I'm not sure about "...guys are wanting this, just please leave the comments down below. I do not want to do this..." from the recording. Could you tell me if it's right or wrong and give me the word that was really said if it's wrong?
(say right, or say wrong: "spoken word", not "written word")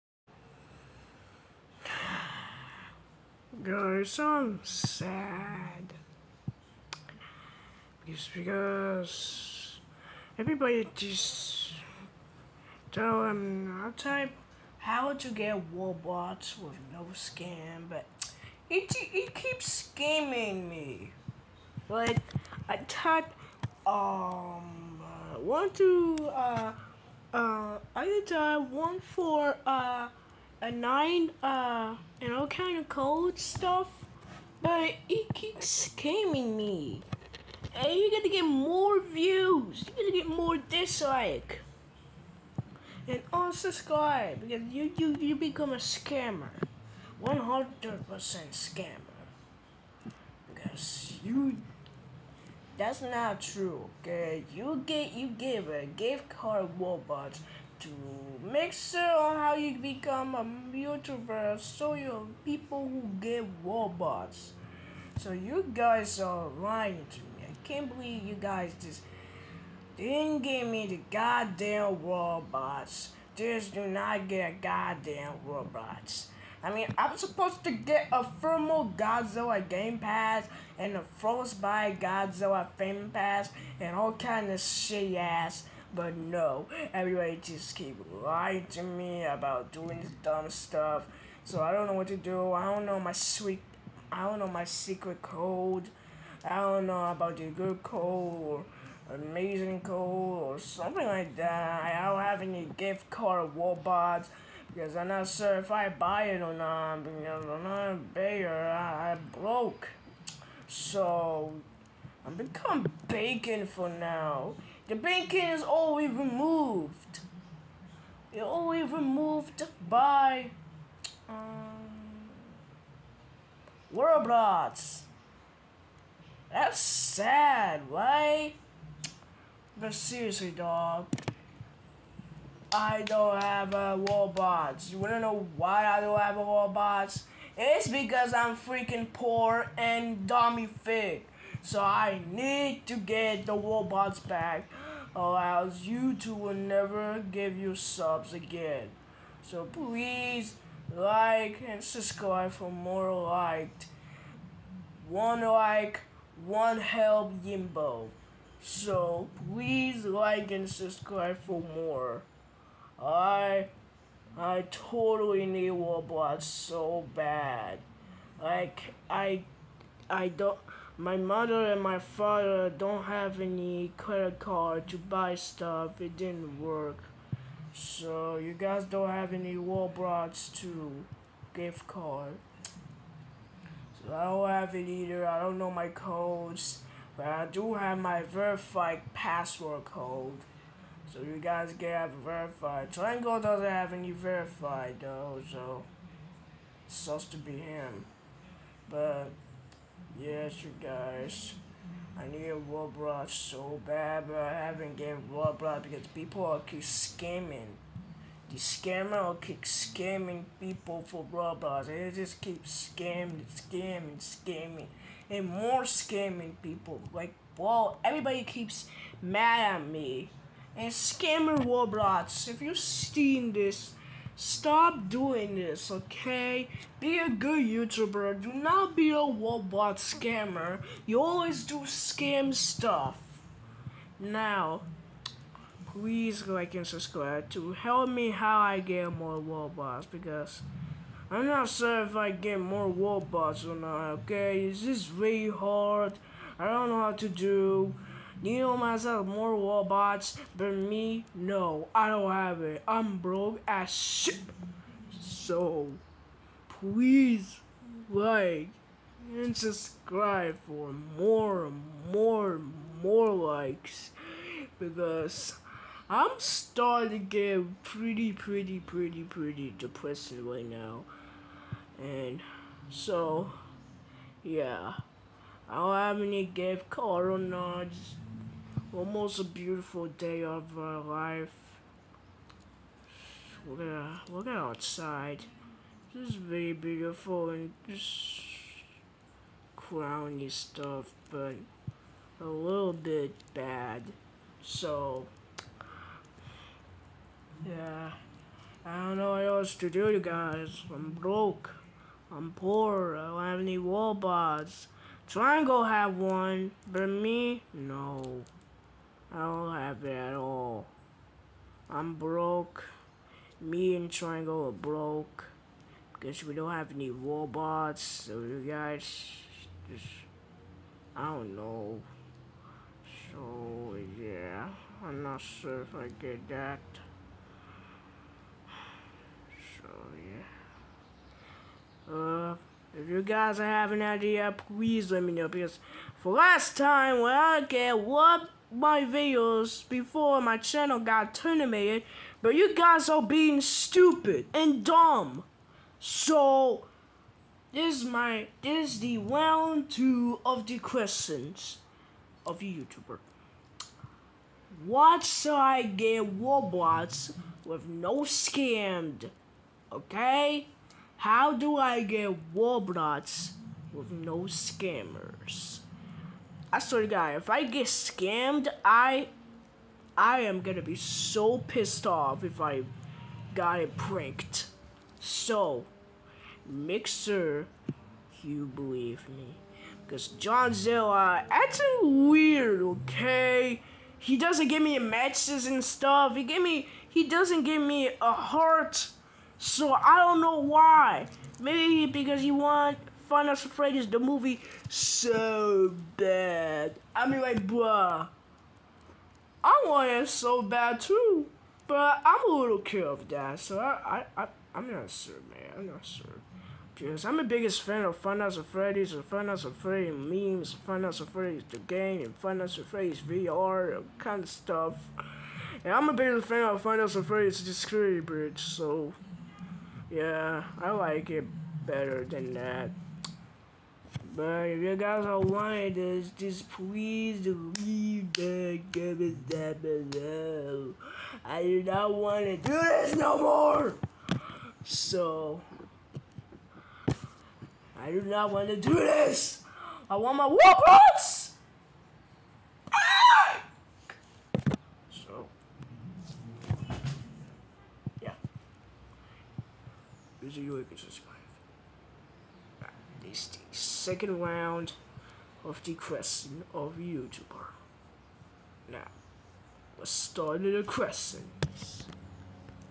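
right.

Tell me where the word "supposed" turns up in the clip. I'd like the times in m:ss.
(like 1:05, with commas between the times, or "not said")
1:17, 3:16.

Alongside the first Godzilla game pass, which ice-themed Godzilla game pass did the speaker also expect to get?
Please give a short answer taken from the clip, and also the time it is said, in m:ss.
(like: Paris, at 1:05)
Frostbite Godzilla, at 1:21.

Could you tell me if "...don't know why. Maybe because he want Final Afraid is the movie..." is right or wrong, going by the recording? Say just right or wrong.
right.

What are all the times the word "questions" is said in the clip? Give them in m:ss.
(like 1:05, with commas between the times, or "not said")
5:50, 7:35, 7:40.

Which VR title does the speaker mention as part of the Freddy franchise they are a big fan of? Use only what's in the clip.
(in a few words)
Funhouse of Freddy's VR.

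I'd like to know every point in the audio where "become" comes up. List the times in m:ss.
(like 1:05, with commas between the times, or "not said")
0:45, 0:59, 1:52.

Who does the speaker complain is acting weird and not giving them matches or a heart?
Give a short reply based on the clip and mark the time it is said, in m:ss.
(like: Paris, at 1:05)
John Zilla, at 6:20.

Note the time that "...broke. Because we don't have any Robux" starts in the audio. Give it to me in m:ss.
5:14.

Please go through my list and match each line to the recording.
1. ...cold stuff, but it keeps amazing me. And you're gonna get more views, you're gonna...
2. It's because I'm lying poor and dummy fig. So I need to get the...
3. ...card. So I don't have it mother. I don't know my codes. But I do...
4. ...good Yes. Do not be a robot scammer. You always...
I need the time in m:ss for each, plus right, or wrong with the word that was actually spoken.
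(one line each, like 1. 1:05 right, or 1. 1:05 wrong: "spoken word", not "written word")
1. 0:32 wrong: "scamming", not "amazing"
2. 2:17 wrong: "freaking", not "lying"
3. 3:01 wrong: "either", not "mother"
4. 3:47 wrong: "YouTuber", not "Yes".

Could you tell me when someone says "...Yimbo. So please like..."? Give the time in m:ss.
2:37.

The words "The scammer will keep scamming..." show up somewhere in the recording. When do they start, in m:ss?
3:28.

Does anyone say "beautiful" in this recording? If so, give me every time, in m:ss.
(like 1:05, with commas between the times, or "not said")
4:39, 4:46.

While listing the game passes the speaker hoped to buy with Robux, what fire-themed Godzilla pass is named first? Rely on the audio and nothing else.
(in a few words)
Thermal Godzilla.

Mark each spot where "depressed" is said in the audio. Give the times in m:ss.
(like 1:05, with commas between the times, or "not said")
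4:29.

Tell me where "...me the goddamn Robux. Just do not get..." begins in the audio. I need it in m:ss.
1:10.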